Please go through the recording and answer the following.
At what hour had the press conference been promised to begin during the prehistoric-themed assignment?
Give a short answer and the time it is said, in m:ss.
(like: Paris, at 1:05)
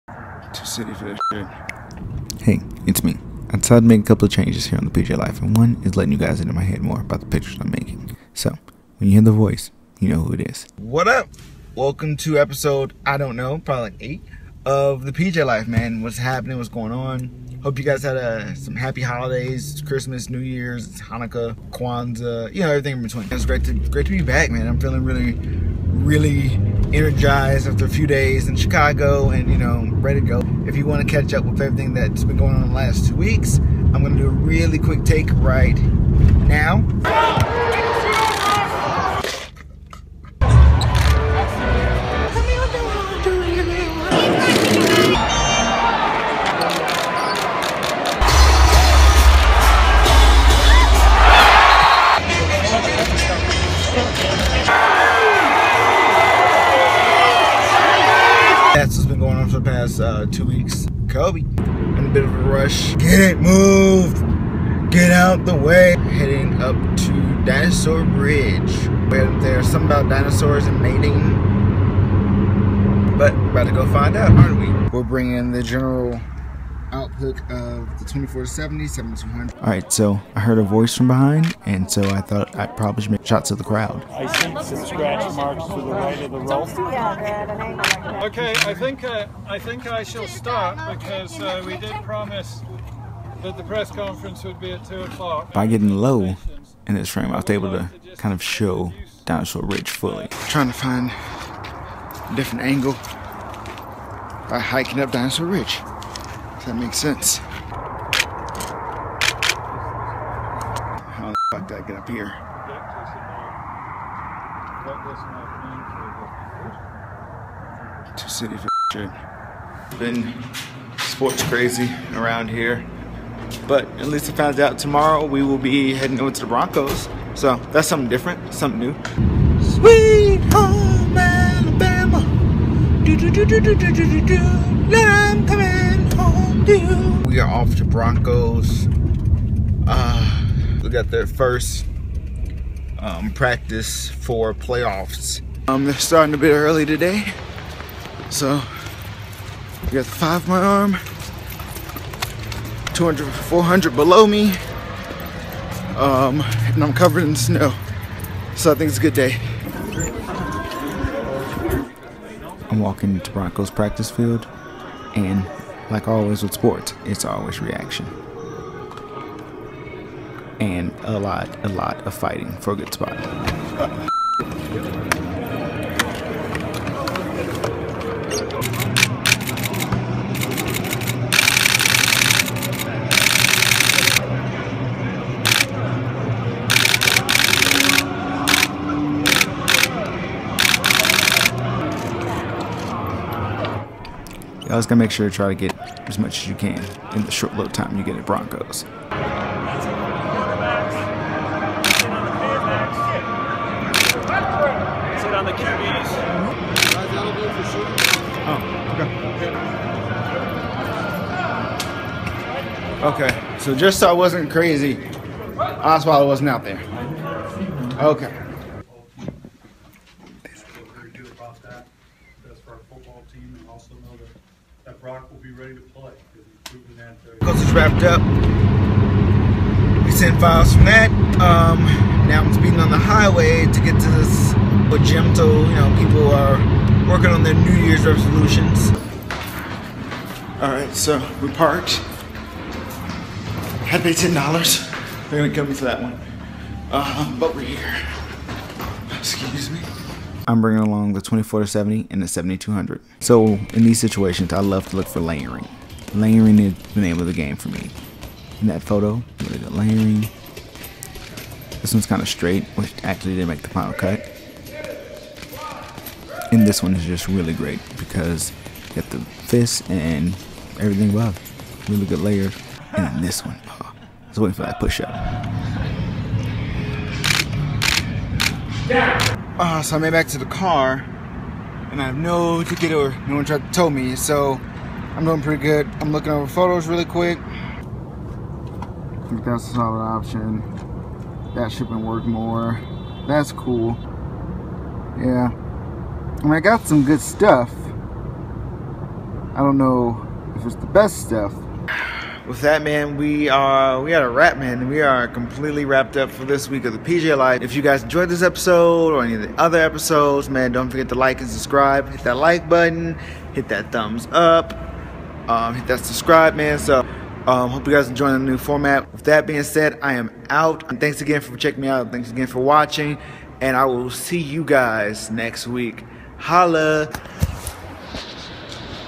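2 o'clock, at 1:34.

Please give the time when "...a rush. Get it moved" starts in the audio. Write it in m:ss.
1:02.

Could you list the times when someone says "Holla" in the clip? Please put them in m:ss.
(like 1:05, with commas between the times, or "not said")
5:26.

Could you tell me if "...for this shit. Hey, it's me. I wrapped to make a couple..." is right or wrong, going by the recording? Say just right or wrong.
wrong.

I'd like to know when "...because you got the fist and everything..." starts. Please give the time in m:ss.
4:27.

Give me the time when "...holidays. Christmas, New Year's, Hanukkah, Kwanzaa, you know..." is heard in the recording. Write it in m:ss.
0:19.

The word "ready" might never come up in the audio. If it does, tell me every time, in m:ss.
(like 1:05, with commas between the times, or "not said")
0:30, 3:45.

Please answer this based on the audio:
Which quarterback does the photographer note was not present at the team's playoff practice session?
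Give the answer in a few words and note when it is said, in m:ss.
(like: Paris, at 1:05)
Osweiler, at 3:35.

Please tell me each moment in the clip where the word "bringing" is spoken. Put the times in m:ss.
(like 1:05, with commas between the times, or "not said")
1:15, 4:10.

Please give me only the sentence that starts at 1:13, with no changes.
But we're about to go find out, aren't we?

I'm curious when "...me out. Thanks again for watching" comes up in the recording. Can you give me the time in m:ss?
5:21.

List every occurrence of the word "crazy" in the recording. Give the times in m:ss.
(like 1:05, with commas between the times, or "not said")
2:01, 3:34.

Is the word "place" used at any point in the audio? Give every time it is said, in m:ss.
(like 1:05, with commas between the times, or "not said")
not said.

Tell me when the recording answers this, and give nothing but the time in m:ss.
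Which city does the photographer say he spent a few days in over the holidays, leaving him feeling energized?
0:28.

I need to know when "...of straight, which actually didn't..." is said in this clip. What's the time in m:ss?
4:22.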